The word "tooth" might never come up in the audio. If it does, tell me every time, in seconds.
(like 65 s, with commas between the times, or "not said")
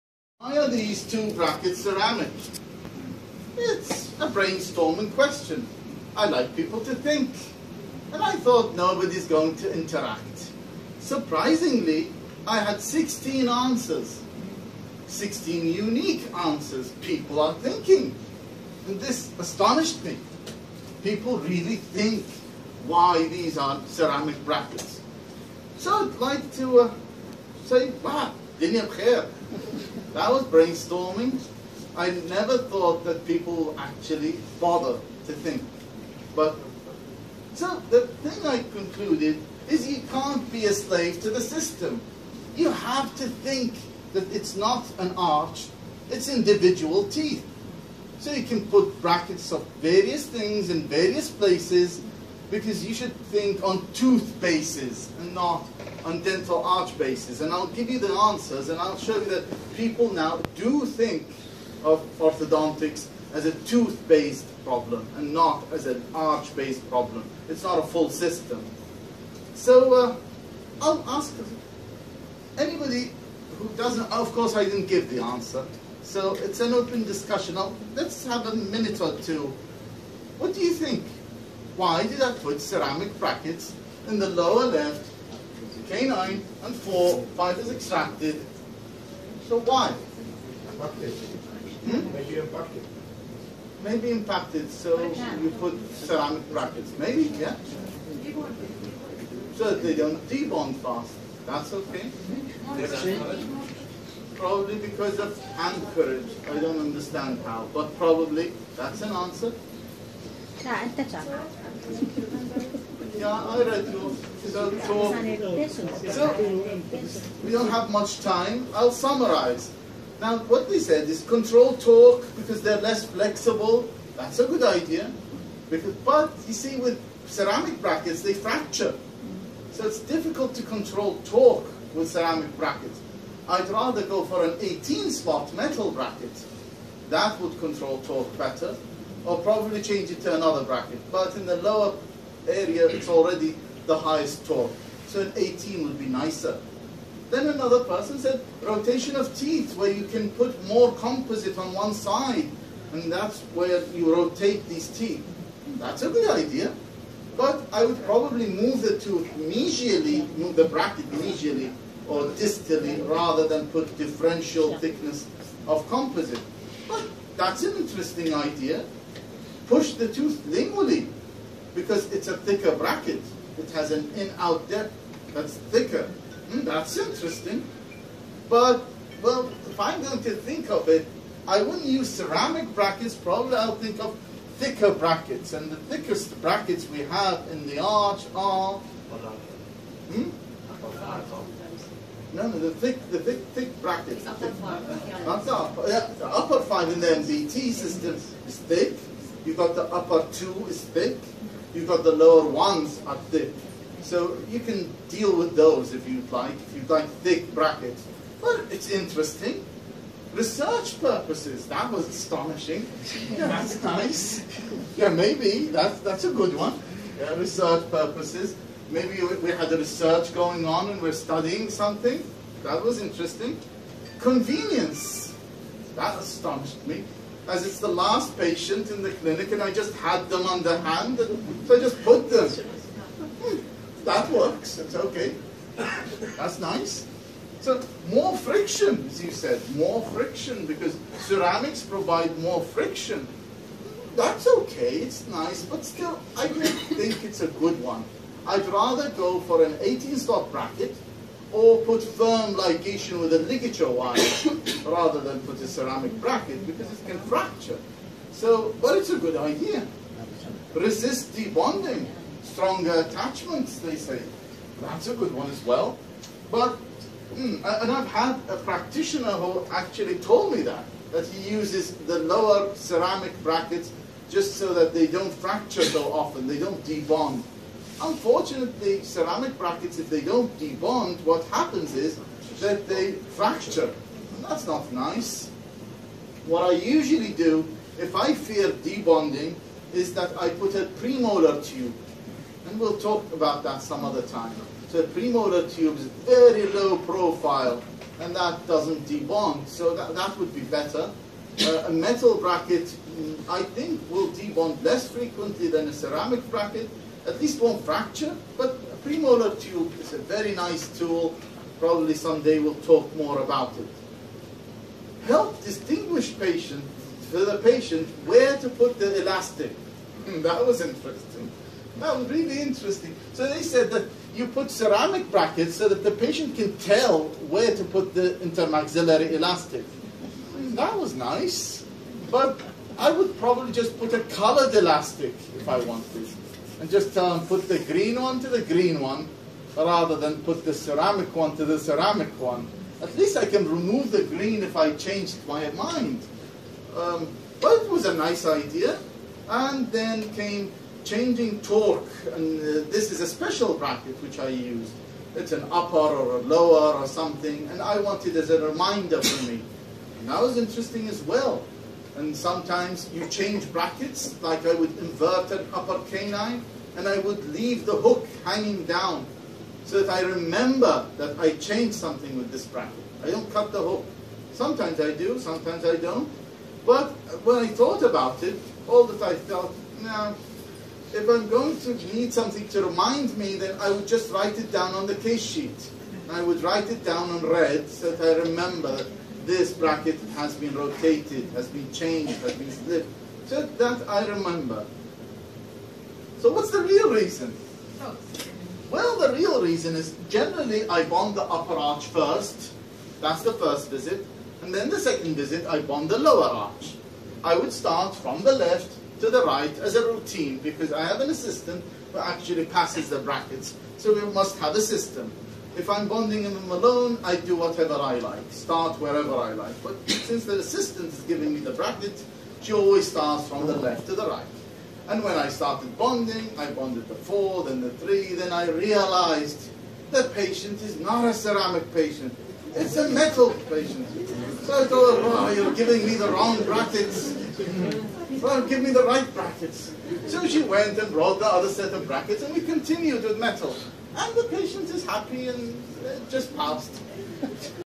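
53 s, 63 s, 158 s, 170 s.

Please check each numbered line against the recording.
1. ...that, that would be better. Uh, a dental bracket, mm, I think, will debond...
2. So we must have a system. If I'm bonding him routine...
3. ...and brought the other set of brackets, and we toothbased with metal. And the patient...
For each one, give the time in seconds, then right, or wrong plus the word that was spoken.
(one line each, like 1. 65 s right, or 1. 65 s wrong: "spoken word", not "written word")
1. 299 s wrong: "metal", not "dental"
2. 413 s wrong: "alone", not "routine"
3. 440 s wrong: "continued", not "toothbased".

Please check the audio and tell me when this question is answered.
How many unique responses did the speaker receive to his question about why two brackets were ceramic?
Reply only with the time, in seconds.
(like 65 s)
15 s.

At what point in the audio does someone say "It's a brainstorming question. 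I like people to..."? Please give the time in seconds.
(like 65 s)
3 s.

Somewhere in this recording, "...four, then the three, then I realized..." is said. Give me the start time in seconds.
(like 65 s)
427 s.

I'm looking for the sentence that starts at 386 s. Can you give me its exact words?
I would write it down on red so that I remember this bracket has been rotated, has been changed, has been slipped.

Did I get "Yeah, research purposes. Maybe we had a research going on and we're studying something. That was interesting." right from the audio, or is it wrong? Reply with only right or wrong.
right.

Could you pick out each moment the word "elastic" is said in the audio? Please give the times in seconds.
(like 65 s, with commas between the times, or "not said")
319 s, 329 s, 334 s.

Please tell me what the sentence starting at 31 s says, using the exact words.
I never thought that people actually bother to think.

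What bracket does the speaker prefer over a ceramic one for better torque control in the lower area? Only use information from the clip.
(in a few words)
18 slot metal bracket.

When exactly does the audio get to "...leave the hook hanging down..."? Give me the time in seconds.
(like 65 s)
367 s.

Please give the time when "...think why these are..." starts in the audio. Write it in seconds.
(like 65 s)
21 s.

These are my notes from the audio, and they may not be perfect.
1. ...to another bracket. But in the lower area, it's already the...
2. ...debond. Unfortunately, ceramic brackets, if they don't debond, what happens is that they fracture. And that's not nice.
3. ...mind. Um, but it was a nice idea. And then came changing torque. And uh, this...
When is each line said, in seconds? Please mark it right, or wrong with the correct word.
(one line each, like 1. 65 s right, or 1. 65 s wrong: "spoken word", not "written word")
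1. 140 s right
2. 276 s right
3. 345 s right.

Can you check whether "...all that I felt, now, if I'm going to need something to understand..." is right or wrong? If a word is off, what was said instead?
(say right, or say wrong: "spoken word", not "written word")
wrong: "remind", not "understand".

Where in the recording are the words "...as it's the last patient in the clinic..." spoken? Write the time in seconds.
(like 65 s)
227 s.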